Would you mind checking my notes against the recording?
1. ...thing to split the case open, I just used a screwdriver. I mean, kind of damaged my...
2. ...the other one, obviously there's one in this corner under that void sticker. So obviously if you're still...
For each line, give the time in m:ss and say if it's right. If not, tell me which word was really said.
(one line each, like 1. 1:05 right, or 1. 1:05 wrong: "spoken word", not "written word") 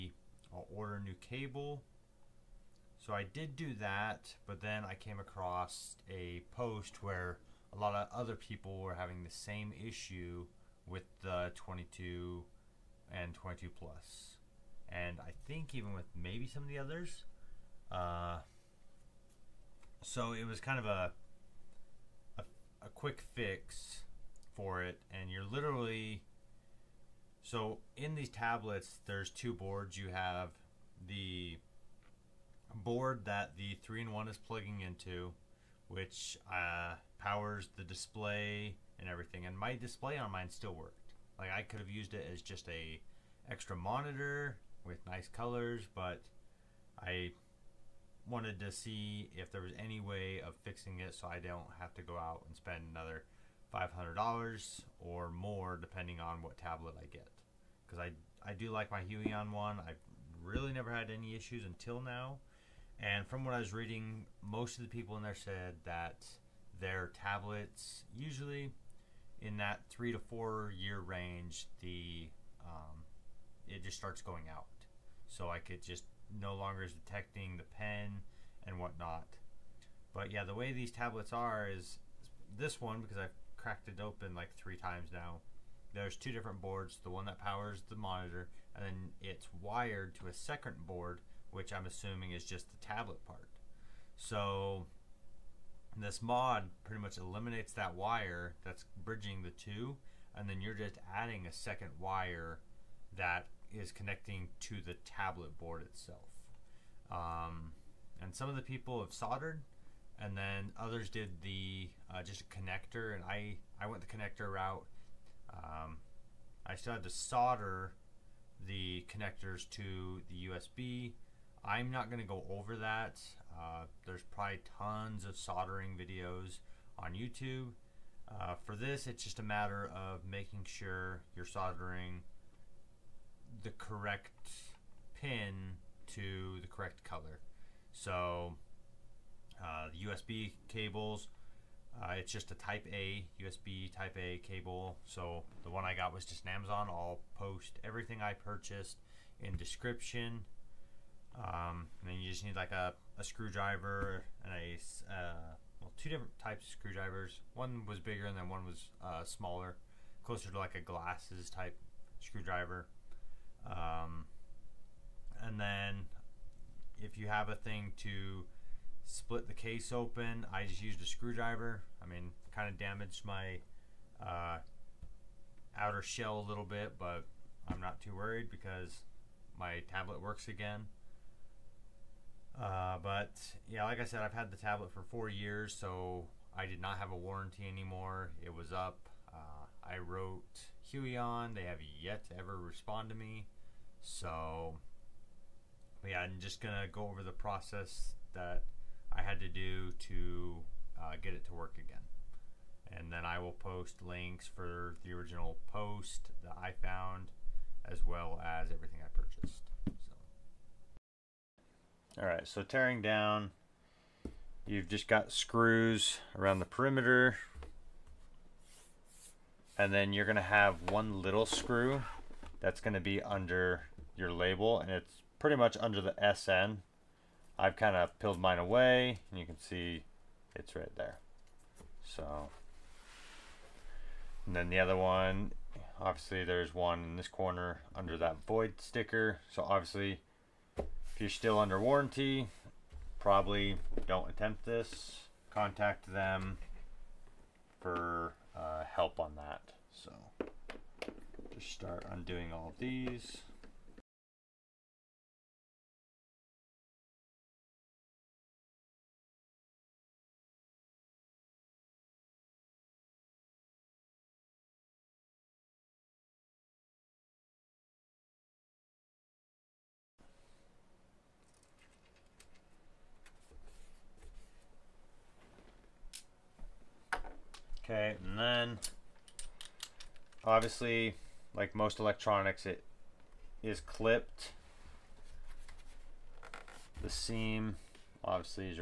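1. 2:47 right
2. 3:54 right.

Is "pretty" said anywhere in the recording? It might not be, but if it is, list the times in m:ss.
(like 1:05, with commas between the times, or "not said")
1:36, 3:45.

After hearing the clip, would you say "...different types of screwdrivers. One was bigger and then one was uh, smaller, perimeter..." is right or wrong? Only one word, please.
wrong.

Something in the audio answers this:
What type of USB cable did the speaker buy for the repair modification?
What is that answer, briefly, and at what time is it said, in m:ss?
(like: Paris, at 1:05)
USB type A, at 2:23.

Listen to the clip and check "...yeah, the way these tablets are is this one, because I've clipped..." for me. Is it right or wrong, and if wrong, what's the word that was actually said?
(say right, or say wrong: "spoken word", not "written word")
wrong: "cracked", not "clipped".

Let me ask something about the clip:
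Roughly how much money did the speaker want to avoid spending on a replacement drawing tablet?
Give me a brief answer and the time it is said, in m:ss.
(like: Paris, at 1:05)
$500, at 0:53.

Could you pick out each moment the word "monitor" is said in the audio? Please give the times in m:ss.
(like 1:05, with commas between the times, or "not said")
0:43, 1:27.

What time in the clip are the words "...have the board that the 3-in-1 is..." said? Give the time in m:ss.
0:30.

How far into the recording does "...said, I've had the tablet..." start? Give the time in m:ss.
3:04.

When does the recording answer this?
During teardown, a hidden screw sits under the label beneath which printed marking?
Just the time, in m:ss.
3:46.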